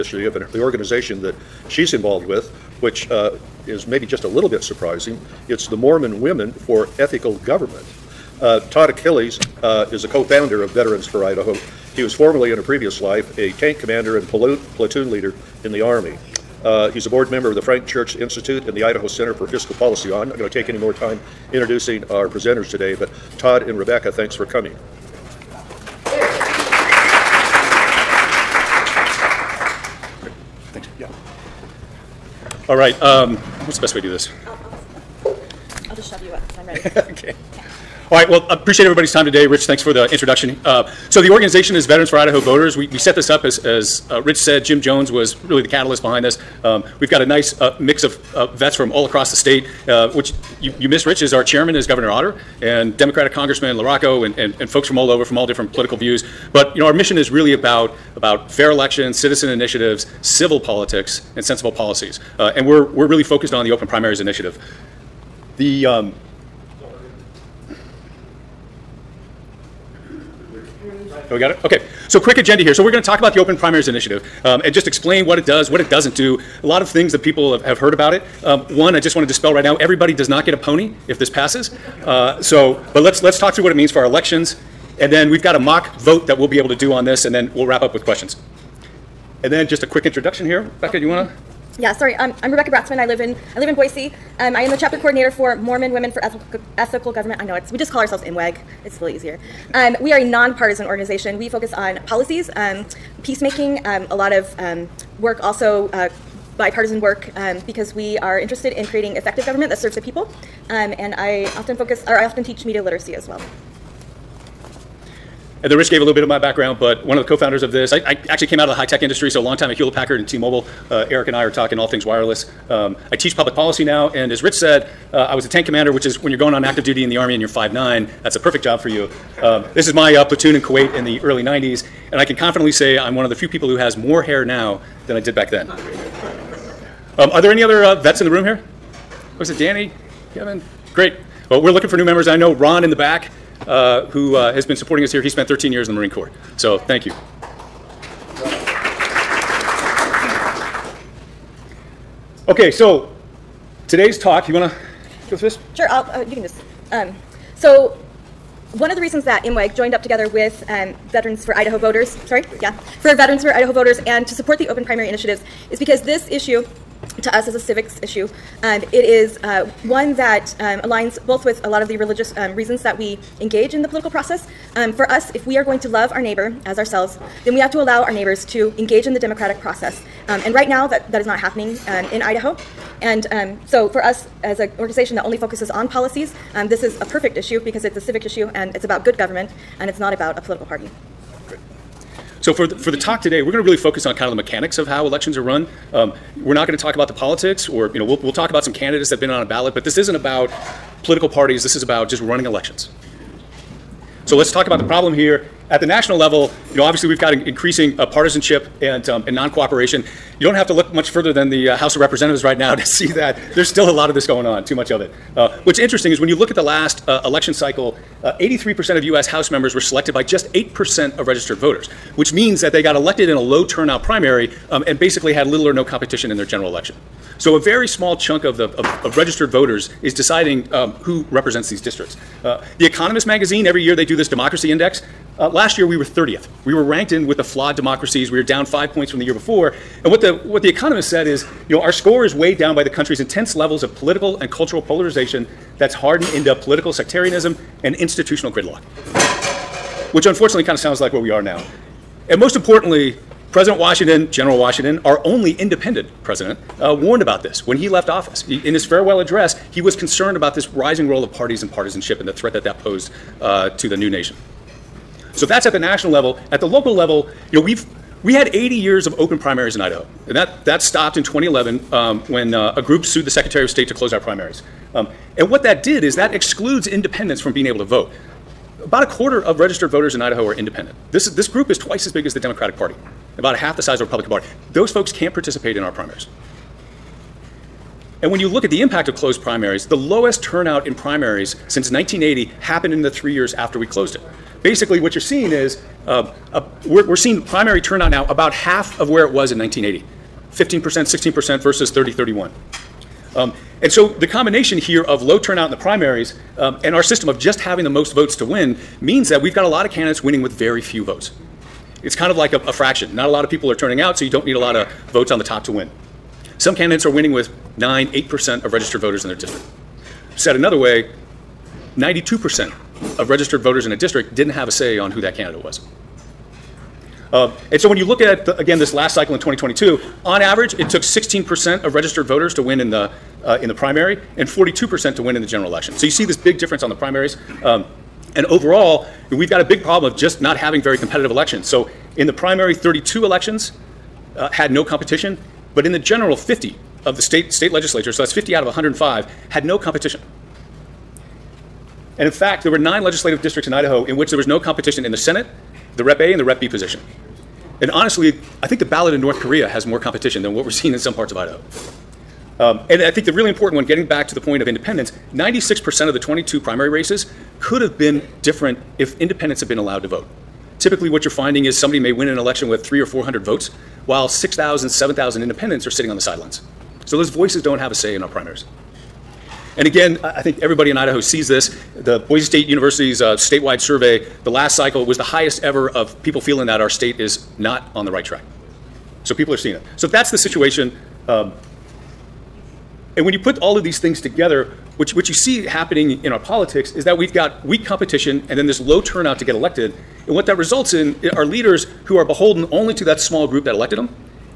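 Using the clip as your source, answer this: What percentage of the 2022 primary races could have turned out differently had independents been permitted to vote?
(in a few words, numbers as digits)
96%.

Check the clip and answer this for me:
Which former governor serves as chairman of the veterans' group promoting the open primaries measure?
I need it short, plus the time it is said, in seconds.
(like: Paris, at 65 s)
Governor Otter, at 51 s.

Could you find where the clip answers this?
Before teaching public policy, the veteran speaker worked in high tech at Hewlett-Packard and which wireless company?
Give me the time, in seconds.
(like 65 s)
120 s.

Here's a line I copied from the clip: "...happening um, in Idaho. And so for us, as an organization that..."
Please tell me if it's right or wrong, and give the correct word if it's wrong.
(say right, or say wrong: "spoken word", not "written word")
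right.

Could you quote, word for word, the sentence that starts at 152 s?
Okay, so today's talk, you want to go through this?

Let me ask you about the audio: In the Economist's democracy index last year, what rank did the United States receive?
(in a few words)
30th.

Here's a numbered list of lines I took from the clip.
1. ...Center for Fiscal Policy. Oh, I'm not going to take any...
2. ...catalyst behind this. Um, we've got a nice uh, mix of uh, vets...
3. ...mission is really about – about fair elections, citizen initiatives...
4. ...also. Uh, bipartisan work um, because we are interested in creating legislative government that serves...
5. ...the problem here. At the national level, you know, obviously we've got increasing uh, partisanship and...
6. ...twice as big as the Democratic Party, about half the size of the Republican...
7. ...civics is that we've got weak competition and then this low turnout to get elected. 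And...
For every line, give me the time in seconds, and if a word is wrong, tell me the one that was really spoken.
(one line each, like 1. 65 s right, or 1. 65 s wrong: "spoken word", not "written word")
1. 19 s right
2. 45 s right
3. 56 s right
4. 105 s wrong: "effective", not "legislative"
5. 204 s right
6. 281 s right
7. 396 s wrong: "politics", not "civics".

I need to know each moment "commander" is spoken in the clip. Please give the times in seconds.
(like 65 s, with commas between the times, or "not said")
13 s, 125 s.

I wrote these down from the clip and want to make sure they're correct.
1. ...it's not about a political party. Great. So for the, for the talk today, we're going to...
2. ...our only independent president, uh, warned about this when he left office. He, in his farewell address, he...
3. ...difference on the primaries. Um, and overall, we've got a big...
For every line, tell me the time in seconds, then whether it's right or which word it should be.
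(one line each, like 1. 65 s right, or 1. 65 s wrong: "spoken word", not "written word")
1. 189 s right
2. 255 s right
3. 336 s right.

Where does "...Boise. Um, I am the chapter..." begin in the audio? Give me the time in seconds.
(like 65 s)
93 s.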